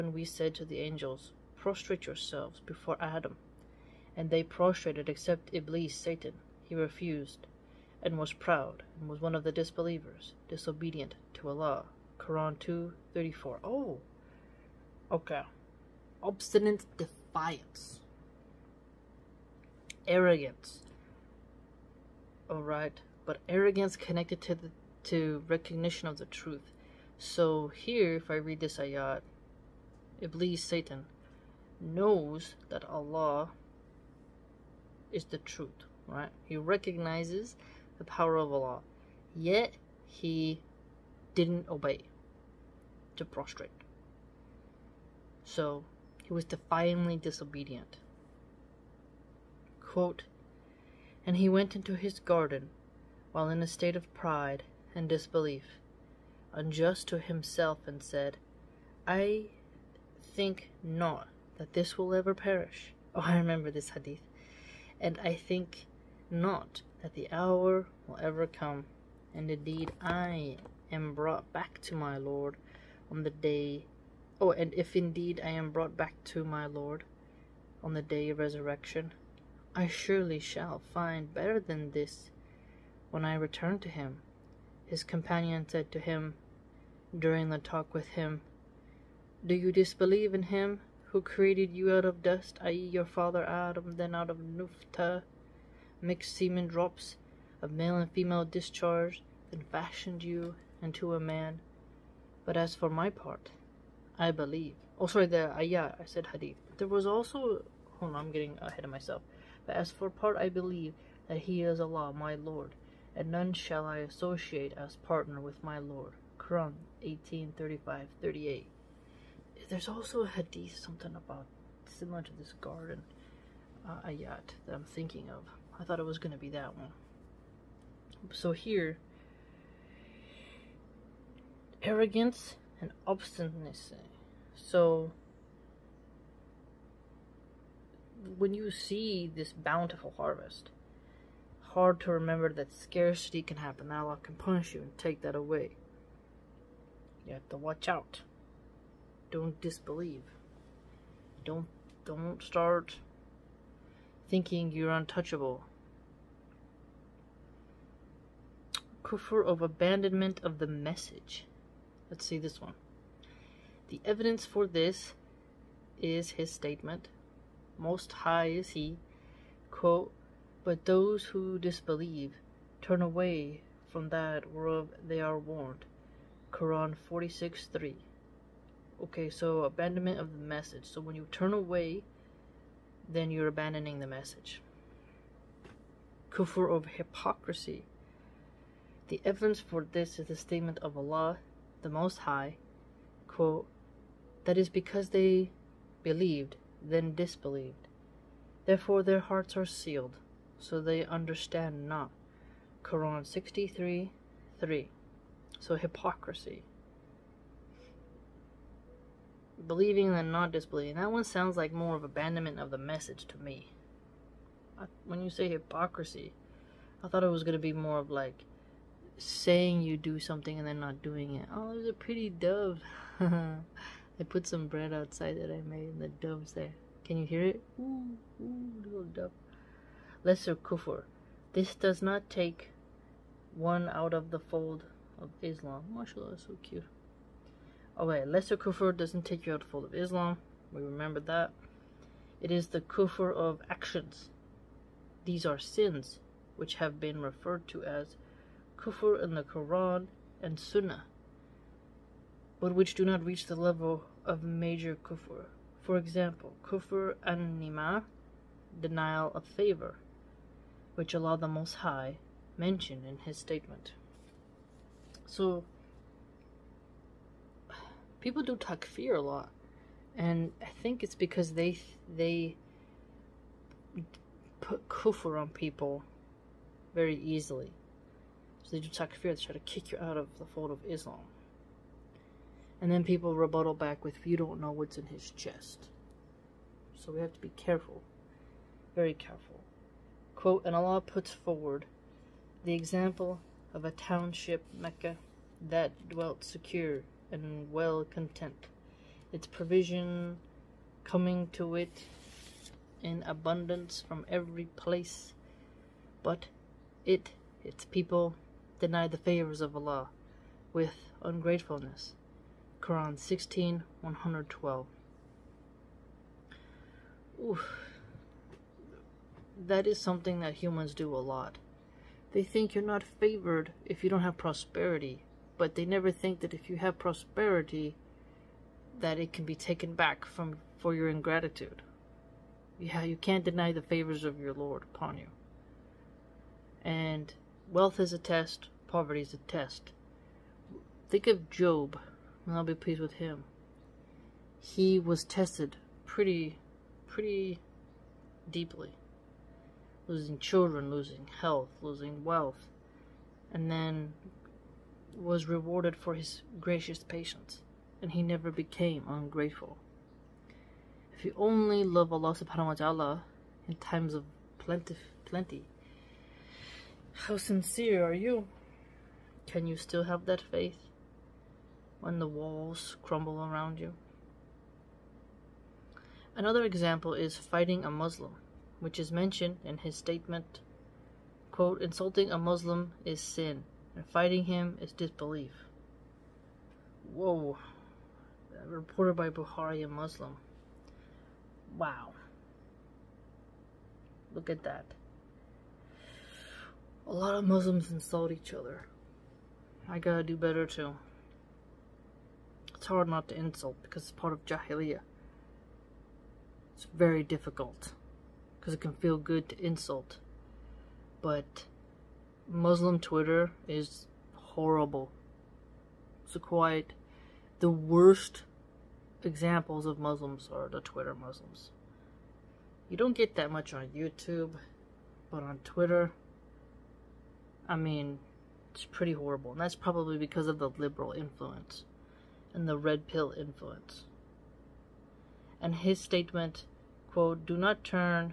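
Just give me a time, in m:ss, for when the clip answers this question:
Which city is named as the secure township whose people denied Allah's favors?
4:54.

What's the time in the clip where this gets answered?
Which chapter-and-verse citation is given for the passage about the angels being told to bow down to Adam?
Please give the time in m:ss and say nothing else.
0:12.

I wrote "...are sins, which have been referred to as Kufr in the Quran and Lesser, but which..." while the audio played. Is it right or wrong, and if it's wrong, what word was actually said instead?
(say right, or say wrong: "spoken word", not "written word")
wrong: "Sunnah", not "Lesser".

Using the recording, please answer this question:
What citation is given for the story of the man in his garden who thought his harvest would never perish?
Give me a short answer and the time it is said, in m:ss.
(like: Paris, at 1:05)
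Quran 18:35-38, at 1:56.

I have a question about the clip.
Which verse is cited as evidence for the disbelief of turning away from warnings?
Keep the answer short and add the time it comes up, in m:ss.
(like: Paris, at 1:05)
Quran 46:3, at 2:56.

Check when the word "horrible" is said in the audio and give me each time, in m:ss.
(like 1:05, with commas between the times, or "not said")
6:54, 7:09.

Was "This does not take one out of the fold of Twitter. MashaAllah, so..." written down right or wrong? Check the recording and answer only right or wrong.
wrong.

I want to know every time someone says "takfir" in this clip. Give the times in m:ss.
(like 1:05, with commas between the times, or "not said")
4:28, 4:38.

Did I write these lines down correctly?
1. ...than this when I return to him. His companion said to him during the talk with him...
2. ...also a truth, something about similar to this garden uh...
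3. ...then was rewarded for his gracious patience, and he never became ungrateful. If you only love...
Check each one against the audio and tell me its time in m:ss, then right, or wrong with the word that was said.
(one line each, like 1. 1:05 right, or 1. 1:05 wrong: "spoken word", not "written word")
1. 1:21 right
2. 1:59 wrong: "hadith", not "truth"
3. 5:53 right.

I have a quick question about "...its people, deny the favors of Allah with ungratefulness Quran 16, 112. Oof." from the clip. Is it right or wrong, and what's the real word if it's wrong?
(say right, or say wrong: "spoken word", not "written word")
right.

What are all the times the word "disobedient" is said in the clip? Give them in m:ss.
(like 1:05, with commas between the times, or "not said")
0:10, 0:47.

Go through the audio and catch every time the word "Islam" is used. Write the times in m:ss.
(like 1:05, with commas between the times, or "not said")
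3:55, 3:59, 4:40.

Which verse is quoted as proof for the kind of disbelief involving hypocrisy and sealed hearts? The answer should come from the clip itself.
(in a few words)
Quran 63:3.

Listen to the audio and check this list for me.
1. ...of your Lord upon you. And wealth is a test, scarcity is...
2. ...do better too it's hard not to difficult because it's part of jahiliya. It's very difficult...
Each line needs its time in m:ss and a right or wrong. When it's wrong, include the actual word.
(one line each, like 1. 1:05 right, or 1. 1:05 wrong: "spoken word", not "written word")
1. 5:34 wrong: "poverty", not "scarcity"
2. 6:40 wrong: "insult", not "difficult".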